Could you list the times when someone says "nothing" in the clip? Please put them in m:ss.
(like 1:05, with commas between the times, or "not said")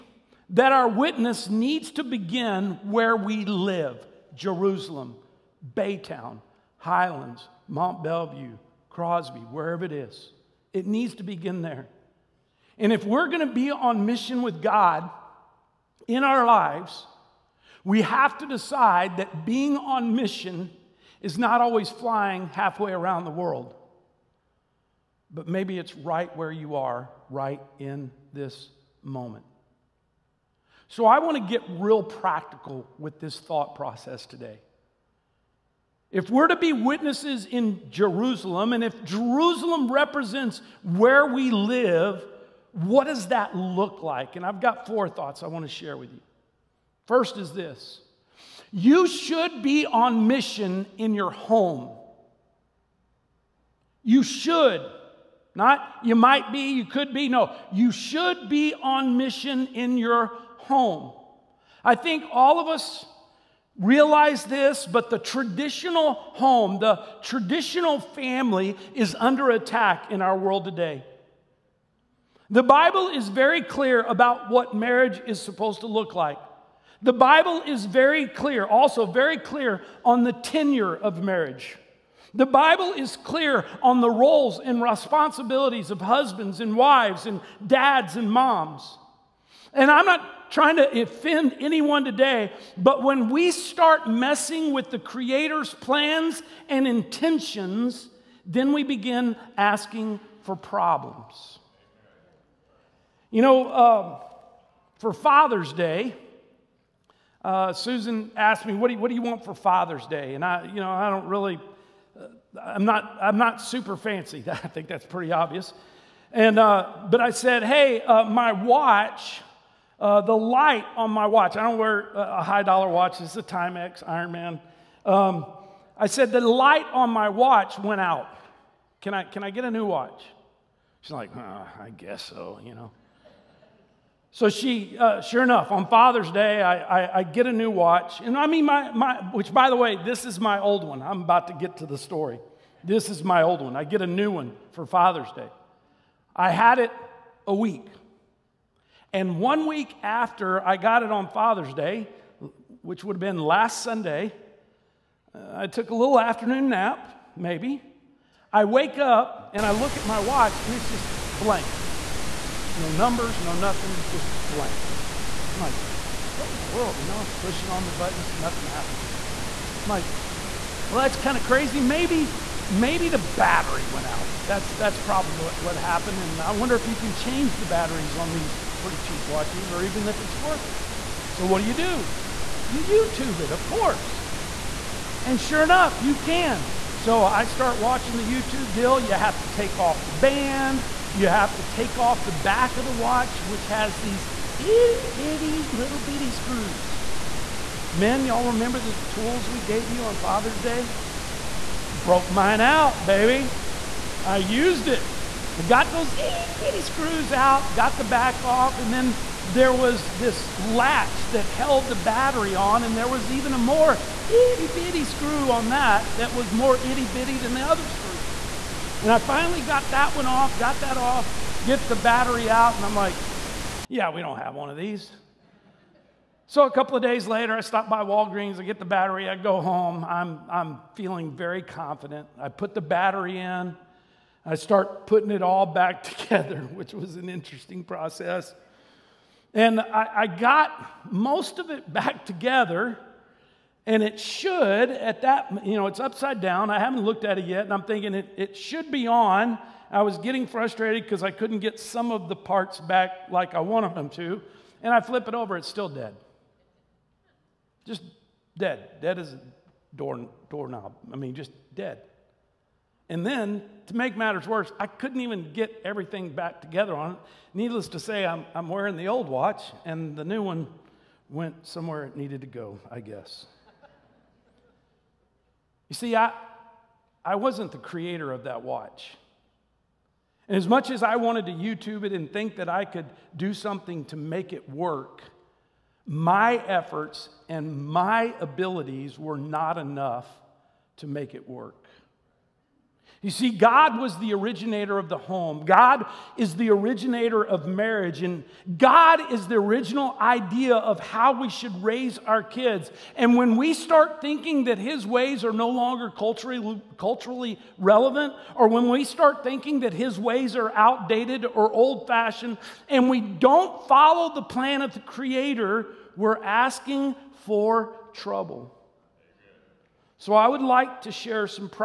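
2:43, 2:48.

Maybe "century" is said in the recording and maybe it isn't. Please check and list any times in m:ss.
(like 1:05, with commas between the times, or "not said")
not said.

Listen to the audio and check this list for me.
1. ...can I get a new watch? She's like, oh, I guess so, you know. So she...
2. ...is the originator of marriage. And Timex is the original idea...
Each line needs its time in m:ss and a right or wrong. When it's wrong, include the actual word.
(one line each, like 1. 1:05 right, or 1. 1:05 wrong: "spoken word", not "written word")
1. 2:09 right
2. 4:56 wrong: "God", not "Timex".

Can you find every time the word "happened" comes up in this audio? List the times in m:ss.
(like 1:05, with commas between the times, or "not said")
2:48, 2:55.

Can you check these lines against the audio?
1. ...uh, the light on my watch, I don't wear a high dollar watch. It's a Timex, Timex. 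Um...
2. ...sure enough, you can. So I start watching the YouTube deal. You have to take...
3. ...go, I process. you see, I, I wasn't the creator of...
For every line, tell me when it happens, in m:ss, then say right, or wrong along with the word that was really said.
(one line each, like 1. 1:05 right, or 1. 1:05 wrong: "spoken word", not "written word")
1. 1:59 wrong: "Ironman", not "Timex"
2. 3:05 right
3. 4:32 wrong: "guess", not "process".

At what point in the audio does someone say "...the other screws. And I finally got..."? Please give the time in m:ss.
3:37.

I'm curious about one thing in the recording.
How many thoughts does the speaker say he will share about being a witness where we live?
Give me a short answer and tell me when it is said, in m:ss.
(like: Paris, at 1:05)
4, at 0:44.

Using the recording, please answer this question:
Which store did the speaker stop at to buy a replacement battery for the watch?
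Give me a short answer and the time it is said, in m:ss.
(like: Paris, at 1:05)
Walgreens, at 3:48.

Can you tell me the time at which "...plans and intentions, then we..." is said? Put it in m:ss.
1:35.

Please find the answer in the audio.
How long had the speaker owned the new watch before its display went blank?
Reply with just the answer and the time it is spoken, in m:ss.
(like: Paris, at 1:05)
a week, at 2:27.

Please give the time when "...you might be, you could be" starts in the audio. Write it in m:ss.
0:56.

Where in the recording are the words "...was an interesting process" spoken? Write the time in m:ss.
3:56.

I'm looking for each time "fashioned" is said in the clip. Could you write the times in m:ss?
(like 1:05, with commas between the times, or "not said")
5:12.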